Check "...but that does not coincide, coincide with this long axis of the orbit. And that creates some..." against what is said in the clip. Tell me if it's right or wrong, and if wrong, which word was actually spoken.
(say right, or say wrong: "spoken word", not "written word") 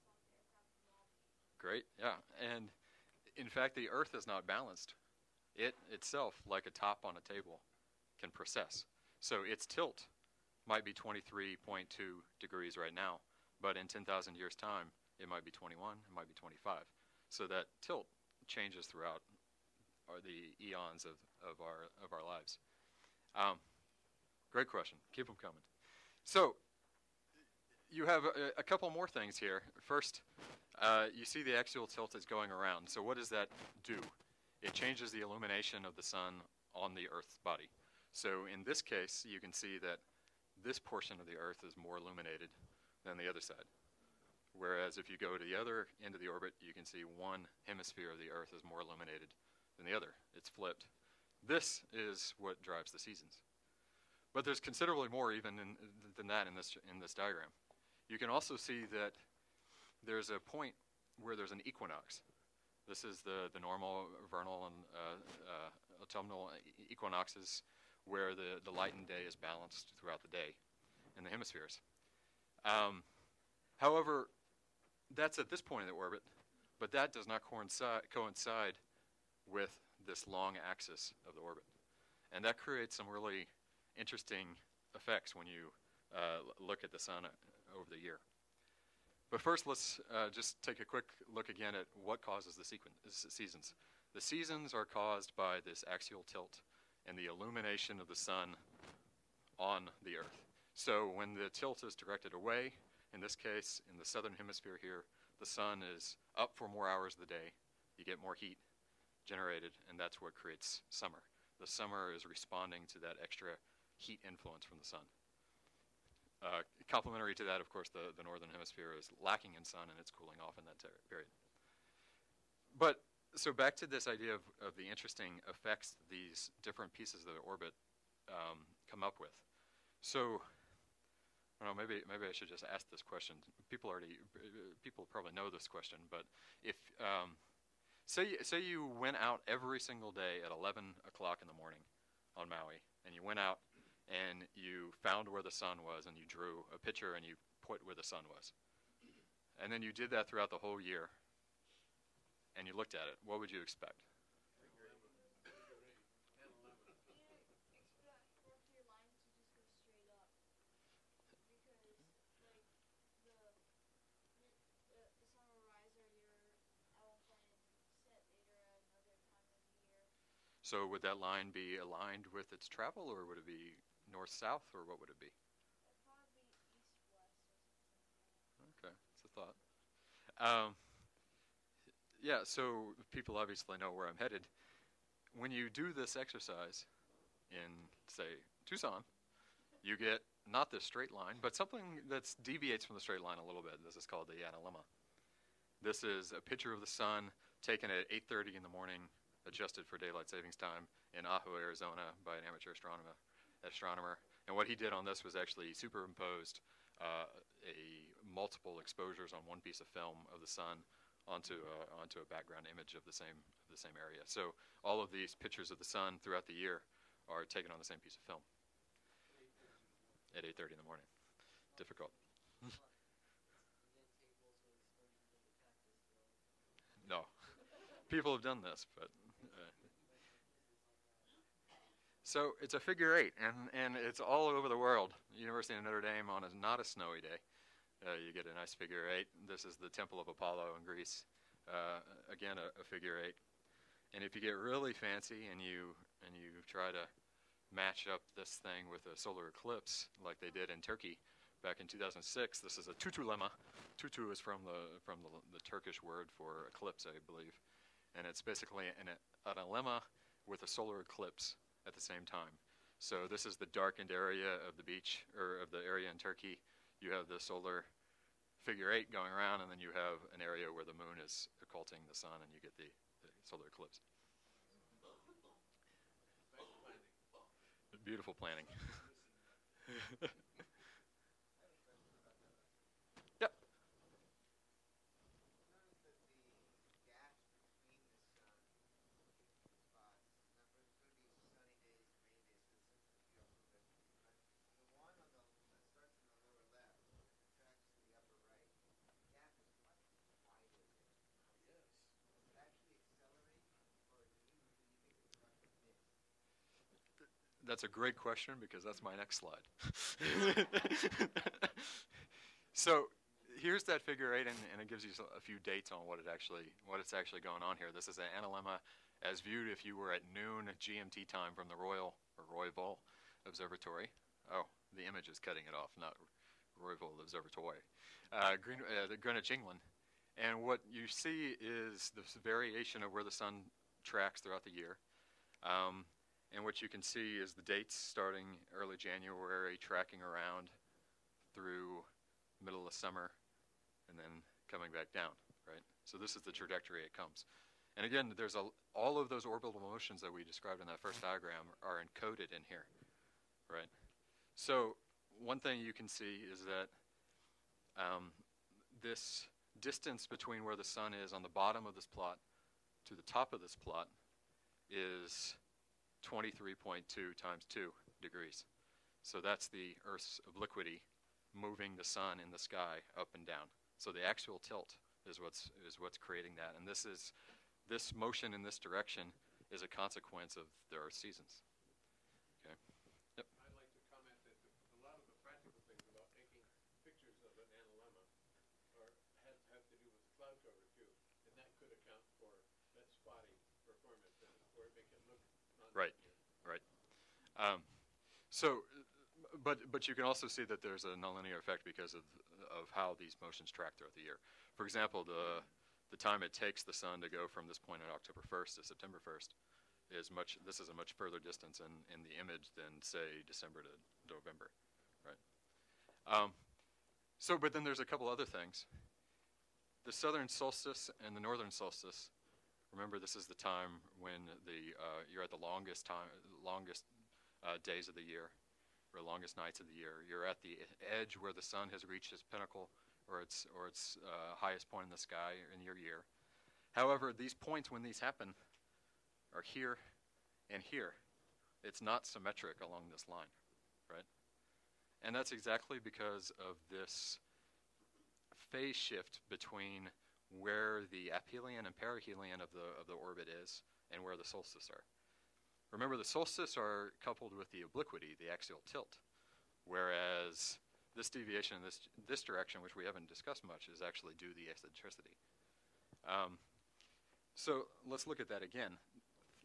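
right.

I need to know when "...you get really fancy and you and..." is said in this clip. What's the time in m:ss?
4:04.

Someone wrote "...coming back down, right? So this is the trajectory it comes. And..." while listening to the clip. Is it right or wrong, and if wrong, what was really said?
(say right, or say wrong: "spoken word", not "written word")
right.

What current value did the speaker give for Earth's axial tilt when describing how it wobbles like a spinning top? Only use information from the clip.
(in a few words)
23.2 degrees.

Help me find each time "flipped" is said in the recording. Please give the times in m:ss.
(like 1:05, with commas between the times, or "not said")
0:50.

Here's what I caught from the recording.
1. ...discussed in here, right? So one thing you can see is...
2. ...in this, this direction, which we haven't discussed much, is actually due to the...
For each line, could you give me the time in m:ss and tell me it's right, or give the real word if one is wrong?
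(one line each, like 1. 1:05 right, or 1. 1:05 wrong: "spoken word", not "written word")
1. 5:52 wrong: "encoded", not "discussed"
2. 7:41 right.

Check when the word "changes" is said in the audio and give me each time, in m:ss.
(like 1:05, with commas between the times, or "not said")
0:18, 0:34.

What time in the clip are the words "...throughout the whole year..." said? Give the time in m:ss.
2:30.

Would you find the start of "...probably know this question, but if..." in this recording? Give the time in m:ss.
2:15.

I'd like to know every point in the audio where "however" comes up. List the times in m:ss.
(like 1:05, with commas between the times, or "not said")
1:13, 7:16.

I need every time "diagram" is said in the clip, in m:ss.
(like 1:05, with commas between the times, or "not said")
0:57, 5:51.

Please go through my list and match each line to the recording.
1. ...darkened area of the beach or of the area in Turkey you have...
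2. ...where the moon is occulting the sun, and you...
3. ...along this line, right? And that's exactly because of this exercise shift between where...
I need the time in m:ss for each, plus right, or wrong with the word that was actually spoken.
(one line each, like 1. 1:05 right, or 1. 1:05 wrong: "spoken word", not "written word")
1. 4:23 right
2. 4:30 right
3. 7:22 wrong: "phase", not "exercise".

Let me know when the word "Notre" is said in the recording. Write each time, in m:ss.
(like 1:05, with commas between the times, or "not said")
3:55.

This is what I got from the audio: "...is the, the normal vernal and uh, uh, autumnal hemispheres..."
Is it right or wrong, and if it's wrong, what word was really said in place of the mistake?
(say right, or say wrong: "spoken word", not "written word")
wrong: "equinoxes", not "hemispheres".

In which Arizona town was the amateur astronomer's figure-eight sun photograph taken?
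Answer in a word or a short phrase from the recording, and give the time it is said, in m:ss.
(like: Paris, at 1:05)
Ajo, at 3:21.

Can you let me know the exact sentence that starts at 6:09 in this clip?
So that's the Earth's obliquity moving the sun in the sky up and down.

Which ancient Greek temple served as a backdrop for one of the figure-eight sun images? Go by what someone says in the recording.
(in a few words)
Temple of Apollo.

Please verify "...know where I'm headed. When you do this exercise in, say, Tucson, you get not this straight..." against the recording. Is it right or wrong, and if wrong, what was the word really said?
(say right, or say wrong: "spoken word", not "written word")
right.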